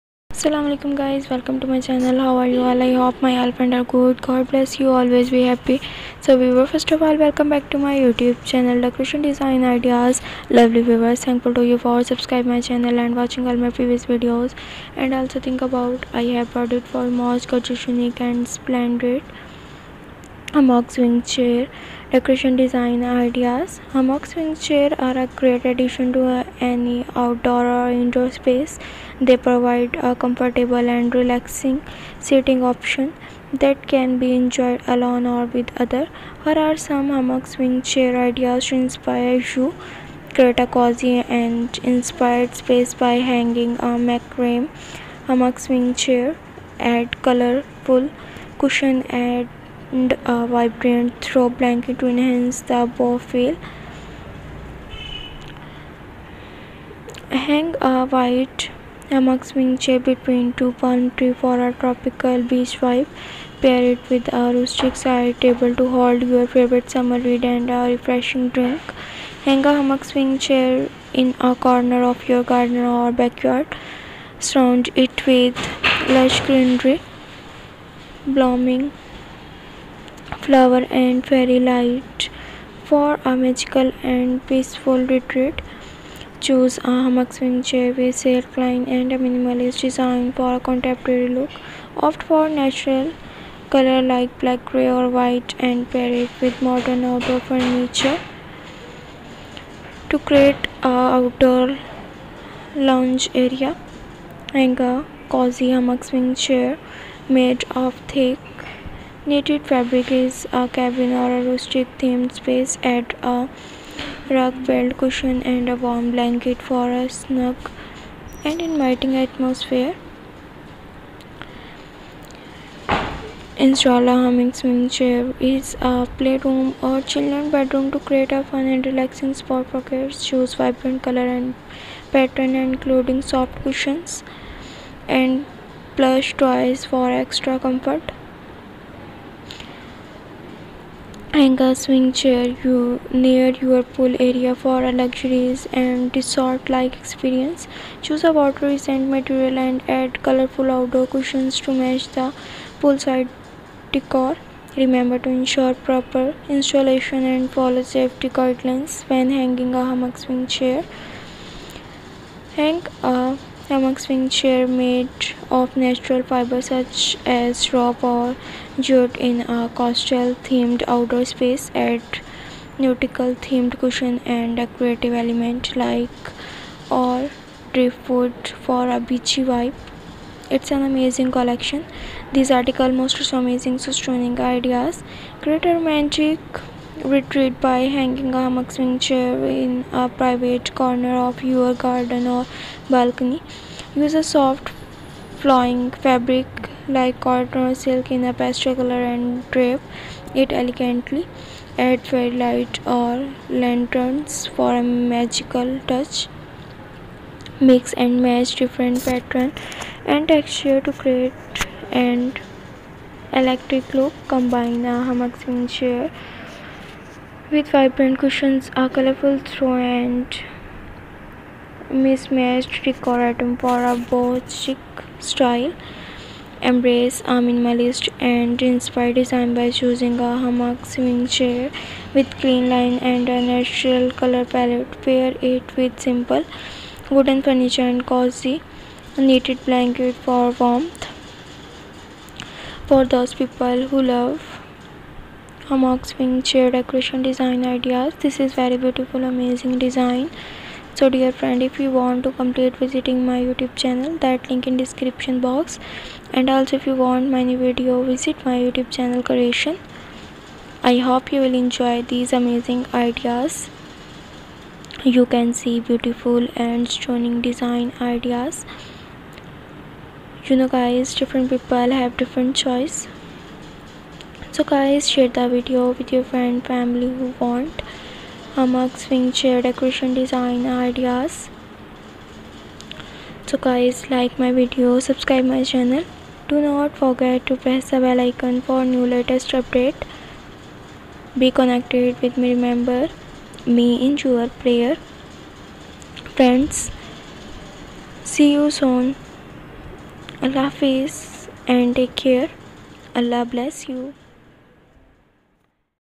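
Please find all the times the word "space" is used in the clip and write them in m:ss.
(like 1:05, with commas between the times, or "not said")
0:28, 0:42, 1:52, 2:51.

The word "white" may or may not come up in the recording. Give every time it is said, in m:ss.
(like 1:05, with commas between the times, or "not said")
0:58, 1:35.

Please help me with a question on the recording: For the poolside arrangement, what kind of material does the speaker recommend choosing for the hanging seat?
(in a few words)
water-resistant material.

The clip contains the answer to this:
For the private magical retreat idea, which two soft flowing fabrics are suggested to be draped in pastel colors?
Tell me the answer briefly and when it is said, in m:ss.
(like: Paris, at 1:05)
cotton or silk, at 3:17.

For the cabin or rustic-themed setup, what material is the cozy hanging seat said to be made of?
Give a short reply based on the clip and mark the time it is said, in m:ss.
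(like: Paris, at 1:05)
thick knitted fabric, at 1:48.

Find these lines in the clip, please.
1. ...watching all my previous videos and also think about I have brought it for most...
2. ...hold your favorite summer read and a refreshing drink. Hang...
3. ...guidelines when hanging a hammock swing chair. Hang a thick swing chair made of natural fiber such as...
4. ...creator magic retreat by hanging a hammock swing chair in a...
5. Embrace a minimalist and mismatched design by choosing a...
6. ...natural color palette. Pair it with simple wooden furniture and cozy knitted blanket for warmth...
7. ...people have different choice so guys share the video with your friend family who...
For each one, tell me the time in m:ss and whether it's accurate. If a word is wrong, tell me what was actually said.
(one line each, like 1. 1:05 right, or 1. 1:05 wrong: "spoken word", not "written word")
1. 0:13 right
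2. 1:05 right
3. 2:38 wrong: "hammock", not "thick"
4. 3:05 right
5. 3:46 wrong: "inspired", not "mismatched"
6. 3:53 right
7. 4:31 right.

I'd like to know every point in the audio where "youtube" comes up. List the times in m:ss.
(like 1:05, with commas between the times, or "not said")
0:08, 4:13, 4:18.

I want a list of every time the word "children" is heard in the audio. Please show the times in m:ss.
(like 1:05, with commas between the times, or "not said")
2:07.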